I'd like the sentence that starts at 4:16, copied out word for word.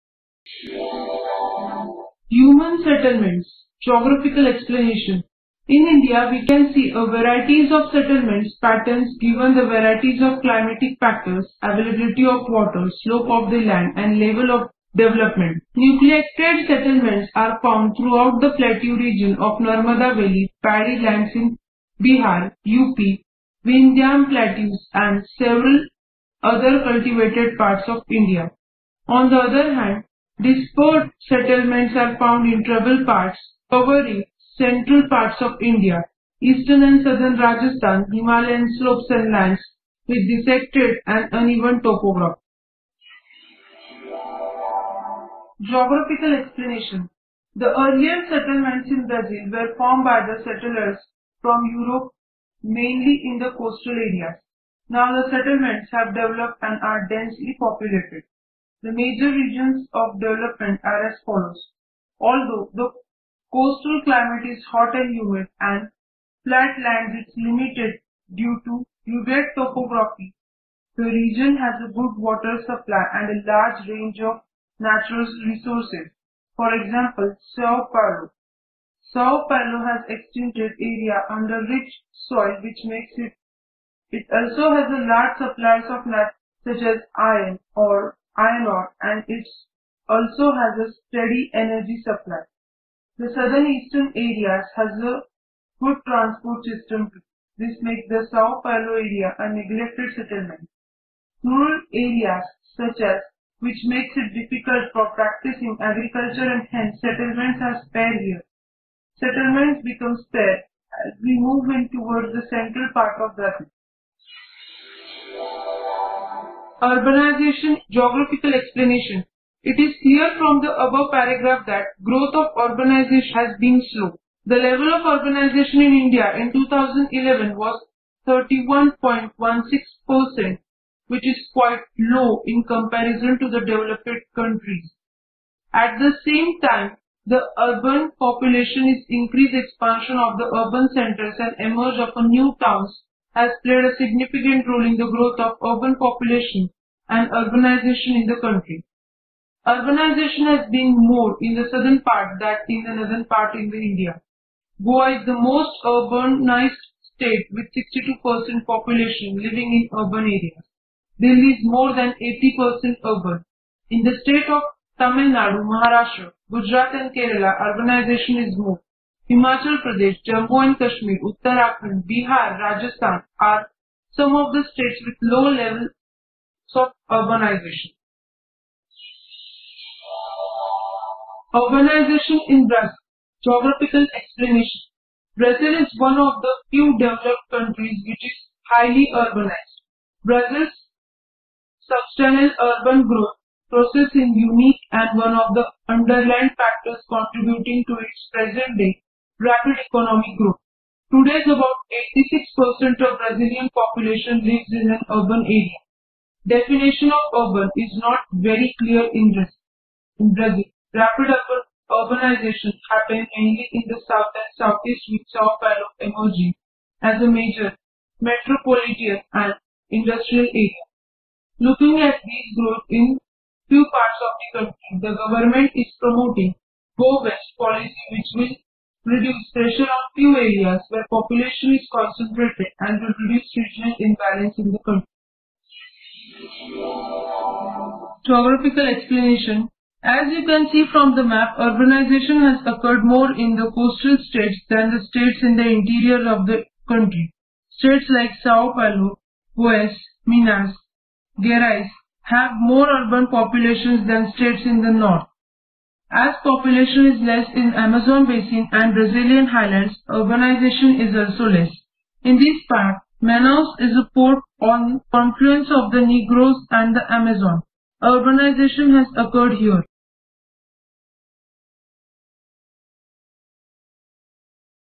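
As population is less in Amazon basin and Brazilian highlands, urbanization is also less.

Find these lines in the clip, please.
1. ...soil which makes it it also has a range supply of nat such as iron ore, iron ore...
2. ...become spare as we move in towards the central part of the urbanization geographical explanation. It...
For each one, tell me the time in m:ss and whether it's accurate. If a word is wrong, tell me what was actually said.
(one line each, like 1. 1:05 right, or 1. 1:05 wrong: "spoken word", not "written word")
1. 1:22 wrong: "large", not "range"
2. 1:49 right.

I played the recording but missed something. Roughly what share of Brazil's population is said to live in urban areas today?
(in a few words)
86%.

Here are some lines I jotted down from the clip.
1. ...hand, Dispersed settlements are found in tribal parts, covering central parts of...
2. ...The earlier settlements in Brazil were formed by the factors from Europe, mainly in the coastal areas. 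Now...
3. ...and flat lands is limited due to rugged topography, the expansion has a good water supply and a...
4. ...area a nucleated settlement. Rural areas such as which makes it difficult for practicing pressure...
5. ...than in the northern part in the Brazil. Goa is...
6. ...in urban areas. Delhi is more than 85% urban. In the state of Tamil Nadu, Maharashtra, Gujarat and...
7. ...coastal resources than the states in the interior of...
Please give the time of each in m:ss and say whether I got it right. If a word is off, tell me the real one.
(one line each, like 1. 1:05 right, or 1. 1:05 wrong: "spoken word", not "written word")
1. 0:29 right
2. 0:47 wrong: "settlers", not "factors"
3. 1:05 wrong: "region", not "expansion"
4. 1:39 wrong: "agriculture", not "pressure"
5. 2:32 wrong: "India", not "Brazil"
6. 2:39 wrong: "80", not "85"
7. 4:03 wrong: "states", not "resources".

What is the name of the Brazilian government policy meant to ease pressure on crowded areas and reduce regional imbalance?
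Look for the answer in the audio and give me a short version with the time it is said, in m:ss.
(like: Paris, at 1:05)
Go West policy, at 3:47.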